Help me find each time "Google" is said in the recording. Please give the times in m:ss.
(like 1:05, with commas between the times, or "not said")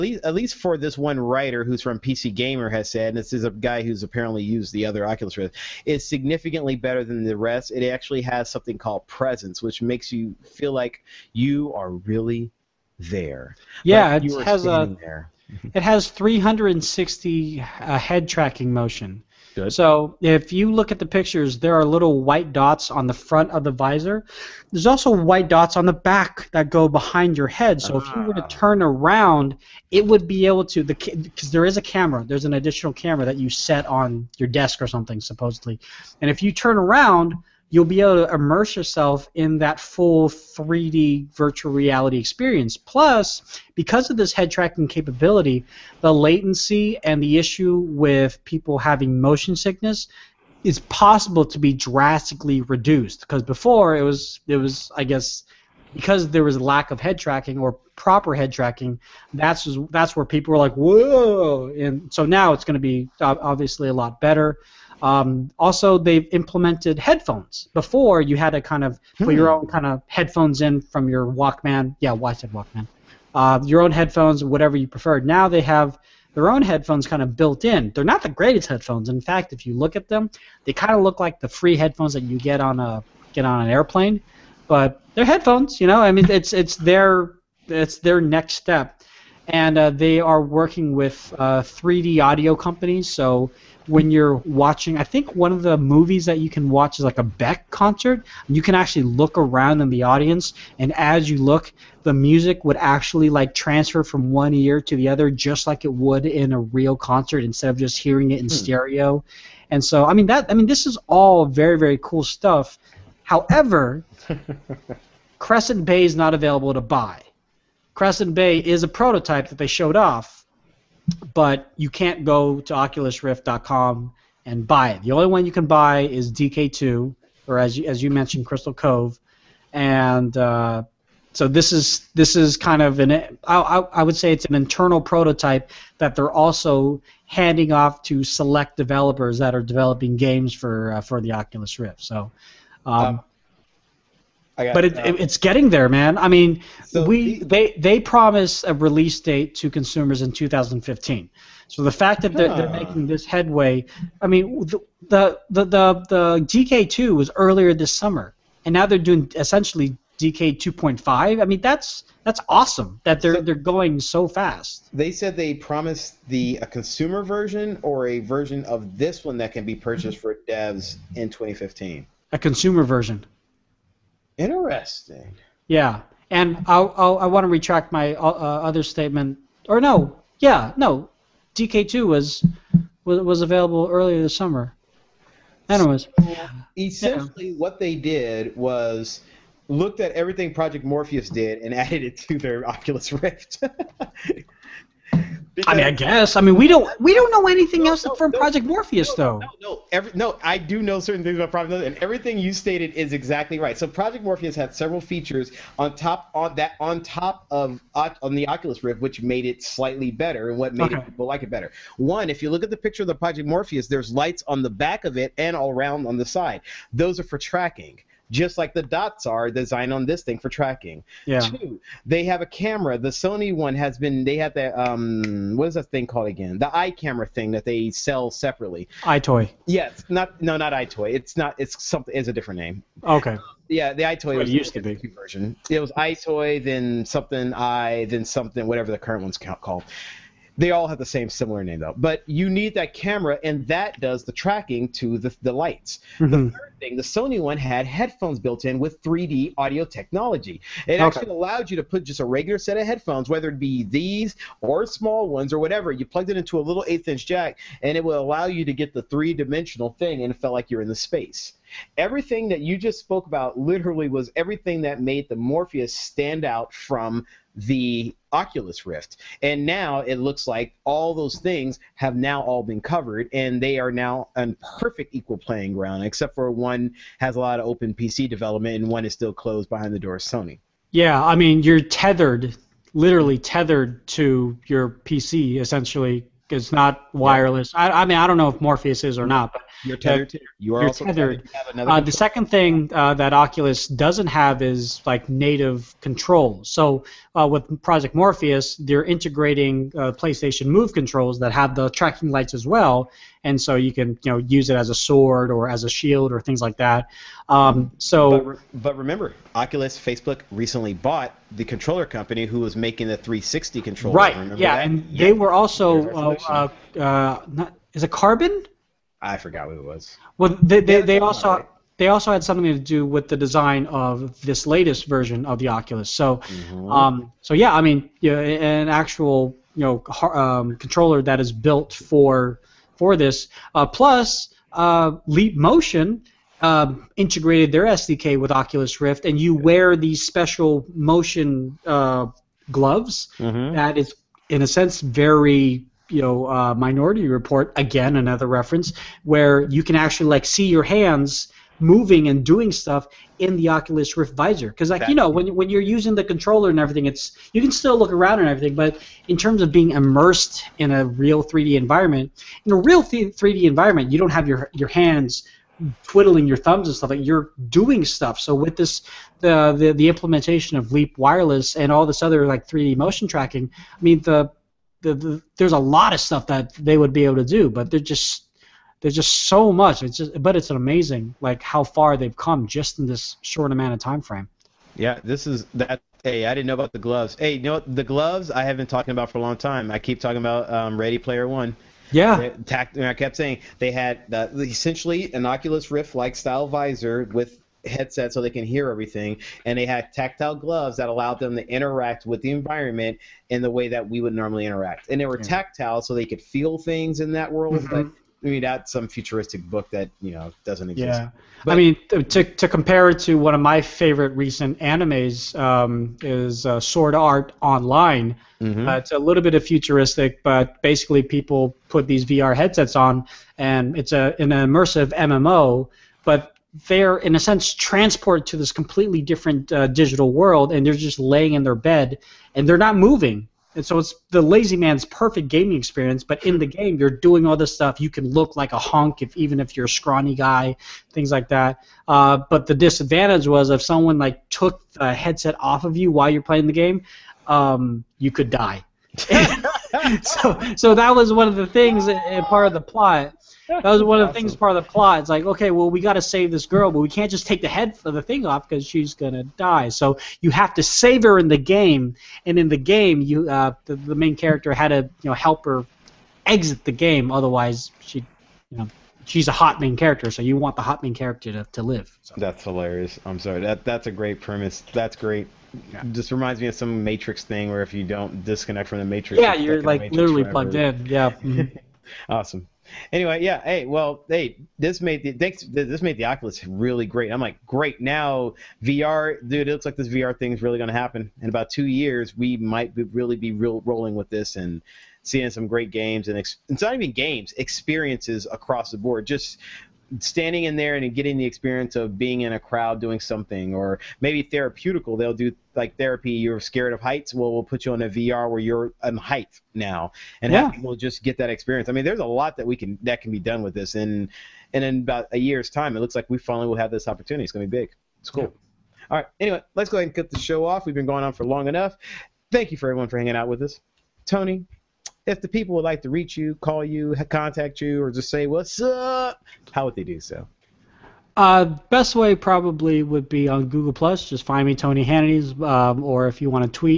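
8:53.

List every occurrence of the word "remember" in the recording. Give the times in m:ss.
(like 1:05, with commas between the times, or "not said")
5:08, 5:14.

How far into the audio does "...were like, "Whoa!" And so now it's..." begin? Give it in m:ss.
1:00.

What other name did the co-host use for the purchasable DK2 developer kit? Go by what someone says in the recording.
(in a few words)
Crystal Cove.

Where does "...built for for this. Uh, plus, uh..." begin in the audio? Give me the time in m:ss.
5:31.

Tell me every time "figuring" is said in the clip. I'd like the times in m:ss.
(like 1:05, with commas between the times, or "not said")
not said.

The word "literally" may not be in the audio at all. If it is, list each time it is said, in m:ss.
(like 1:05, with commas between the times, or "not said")
4:23, 4:42, 8:00.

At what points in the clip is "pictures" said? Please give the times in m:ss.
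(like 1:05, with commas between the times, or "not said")
0:21, 3:32.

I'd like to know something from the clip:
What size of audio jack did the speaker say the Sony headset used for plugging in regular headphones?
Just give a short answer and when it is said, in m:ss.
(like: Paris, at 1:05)
eighth-inch, at 4:16.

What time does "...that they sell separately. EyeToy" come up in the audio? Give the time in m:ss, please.
3:47.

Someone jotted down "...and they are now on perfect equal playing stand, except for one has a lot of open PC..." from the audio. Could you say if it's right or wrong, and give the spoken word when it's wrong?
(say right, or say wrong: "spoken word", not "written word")
wrong: "ground", not "stand".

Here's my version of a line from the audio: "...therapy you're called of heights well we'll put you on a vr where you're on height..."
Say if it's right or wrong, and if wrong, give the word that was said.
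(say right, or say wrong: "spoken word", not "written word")
wrong: "scared", not "called".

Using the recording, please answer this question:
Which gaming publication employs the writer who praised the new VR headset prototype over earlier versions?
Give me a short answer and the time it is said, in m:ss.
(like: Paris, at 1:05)
PC Gamer, at 0:01.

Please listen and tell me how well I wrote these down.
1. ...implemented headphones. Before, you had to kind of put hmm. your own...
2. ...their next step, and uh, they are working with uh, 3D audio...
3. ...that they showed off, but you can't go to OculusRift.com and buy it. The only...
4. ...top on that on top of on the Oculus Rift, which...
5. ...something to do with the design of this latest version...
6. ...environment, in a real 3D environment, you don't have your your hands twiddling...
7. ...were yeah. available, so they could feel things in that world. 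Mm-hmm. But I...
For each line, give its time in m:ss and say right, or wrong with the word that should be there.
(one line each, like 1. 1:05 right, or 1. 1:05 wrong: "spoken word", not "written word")
1. 1:06 right
2. 1:27 right
3. 1:59 right
4. 3:25 right
5. 5:22 right
6. 6:01 right
7. 6:45 wrong: "tactile", not "available".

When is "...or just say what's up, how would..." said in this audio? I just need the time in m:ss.
8:48.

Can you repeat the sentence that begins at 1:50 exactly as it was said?
I mean, this is all very, very cool stuff.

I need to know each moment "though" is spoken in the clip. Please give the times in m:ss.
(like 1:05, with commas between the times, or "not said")
3:19, 4:01.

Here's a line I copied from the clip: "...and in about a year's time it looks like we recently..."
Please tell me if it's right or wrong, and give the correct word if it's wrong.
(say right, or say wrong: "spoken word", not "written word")
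wrong: "finally", not "recently".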